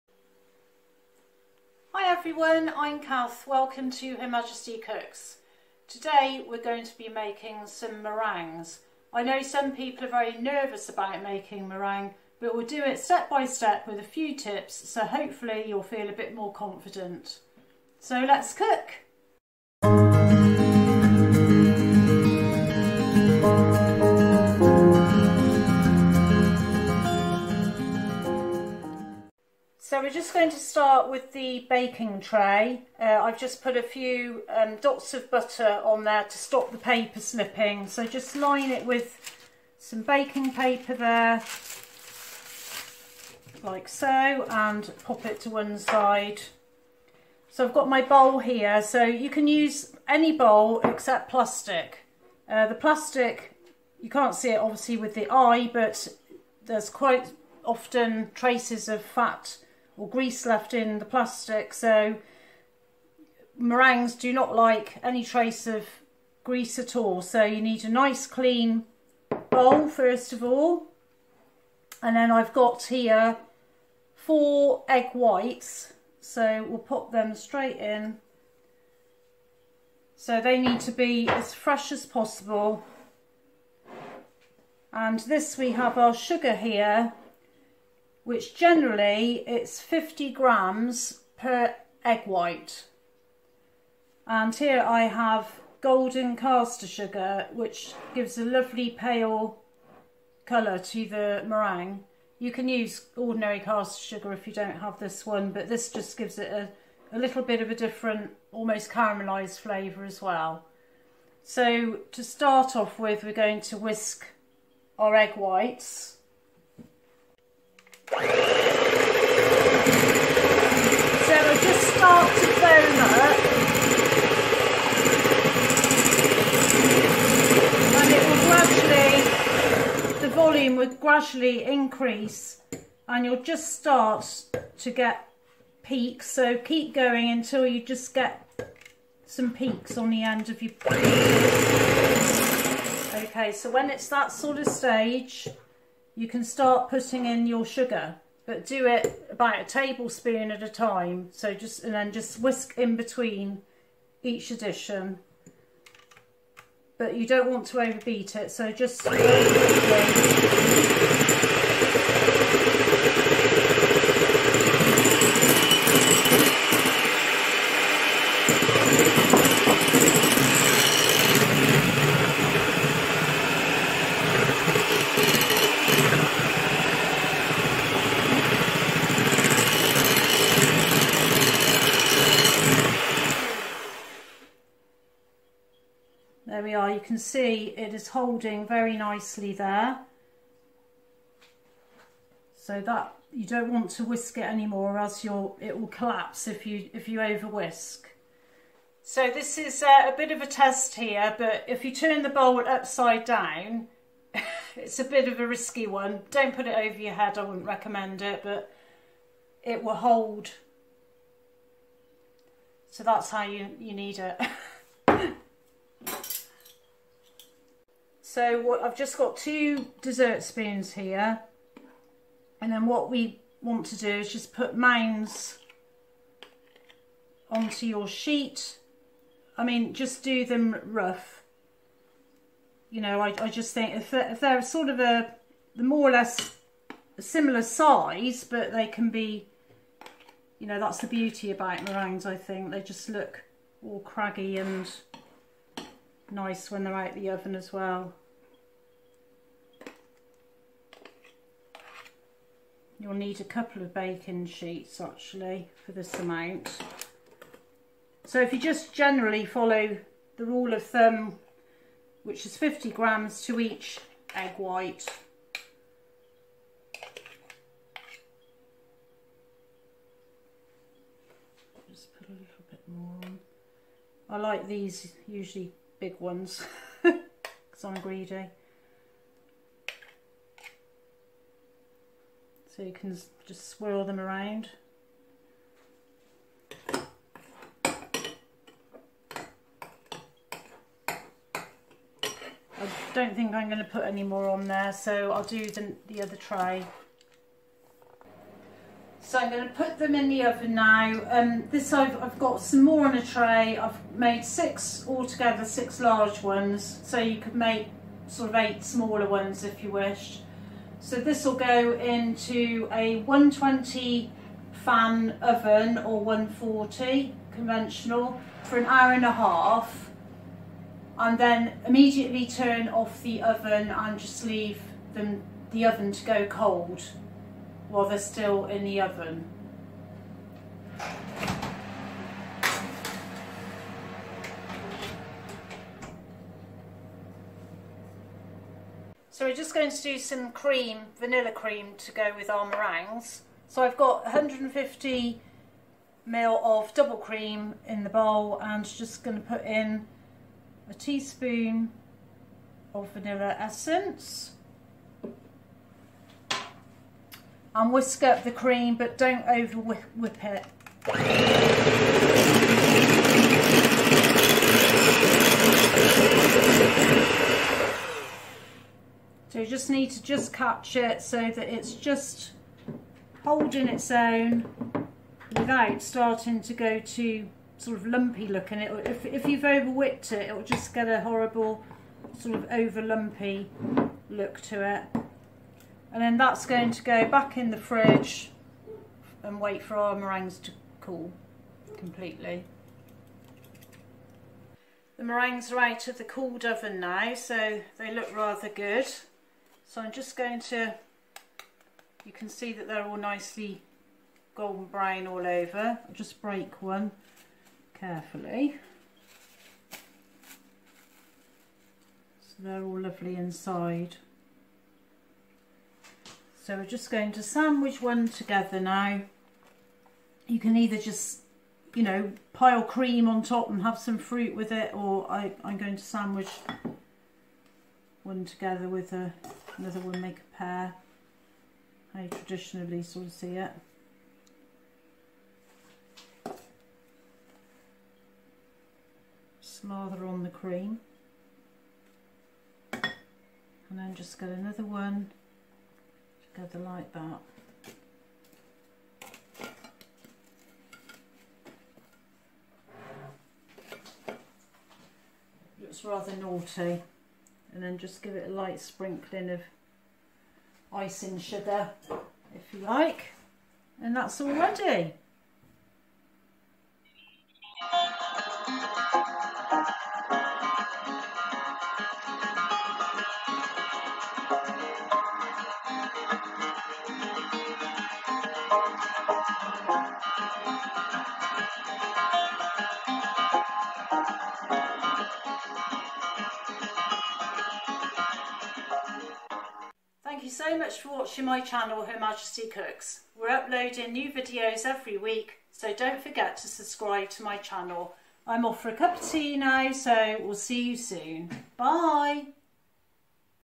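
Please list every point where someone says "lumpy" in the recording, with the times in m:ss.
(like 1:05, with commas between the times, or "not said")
6:18, 6:23.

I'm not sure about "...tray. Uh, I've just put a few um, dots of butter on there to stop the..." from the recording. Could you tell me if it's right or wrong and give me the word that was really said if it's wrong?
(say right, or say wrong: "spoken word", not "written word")
right.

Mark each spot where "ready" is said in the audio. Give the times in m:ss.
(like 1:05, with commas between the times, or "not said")
7:44.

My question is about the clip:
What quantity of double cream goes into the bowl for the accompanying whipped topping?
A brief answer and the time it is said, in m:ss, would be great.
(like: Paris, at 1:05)
150 ml, at 5:44.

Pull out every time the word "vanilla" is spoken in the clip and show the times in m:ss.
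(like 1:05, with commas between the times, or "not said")
5:41, 5:53.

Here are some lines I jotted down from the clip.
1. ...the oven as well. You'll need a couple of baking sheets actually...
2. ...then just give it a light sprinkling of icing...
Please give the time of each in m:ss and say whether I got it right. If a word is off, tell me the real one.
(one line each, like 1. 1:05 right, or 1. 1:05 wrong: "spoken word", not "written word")
1. 4:07 right
2. 7:37 right.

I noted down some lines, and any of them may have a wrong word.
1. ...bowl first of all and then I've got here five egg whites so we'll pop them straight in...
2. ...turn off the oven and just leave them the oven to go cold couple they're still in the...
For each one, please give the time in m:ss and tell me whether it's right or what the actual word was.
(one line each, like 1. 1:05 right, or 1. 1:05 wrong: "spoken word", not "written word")
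1. 1:09 wrong: "four", not "five"
2. 5:22 wrong: "while", not "couple".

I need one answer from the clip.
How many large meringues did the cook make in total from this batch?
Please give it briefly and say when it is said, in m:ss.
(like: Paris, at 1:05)
6, at 5:05.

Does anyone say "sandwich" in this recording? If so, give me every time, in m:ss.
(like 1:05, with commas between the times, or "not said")
6:57, 7:06.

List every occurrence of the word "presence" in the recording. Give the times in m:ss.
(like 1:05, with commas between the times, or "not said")
not said.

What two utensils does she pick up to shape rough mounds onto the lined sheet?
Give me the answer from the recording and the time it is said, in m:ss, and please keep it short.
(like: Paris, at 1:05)
2 dessert spoons, at 3:39.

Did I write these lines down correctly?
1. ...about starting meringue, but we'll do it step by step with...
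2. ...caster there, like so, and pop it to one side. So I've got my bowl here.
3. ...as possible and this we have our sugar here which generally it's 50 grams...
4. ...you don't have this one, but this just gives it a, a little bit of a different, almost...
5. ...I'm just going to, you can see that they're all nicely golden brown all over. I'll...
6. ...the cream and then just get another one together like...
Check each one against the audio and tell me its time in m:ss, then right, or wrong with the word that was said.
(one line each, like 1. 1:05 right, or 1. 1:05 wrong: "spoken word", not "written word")
1. 0:10 wrong: "making", not "starting"
2. 0:40 wrong: "paper", not "caster"
3. 1:21 right
4. 1:44 right
5. 6:39 right
6. 7:20 right.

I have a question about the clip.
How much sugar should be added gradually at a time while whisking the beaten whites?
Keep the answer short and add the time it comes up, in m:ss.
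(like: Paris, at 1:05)
a tablespoon, at 2:29.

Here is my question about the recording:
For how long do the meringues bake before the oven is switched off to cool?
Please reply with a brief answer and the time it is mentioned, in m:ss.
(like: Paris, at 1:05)
an hour and a half, at 5:18.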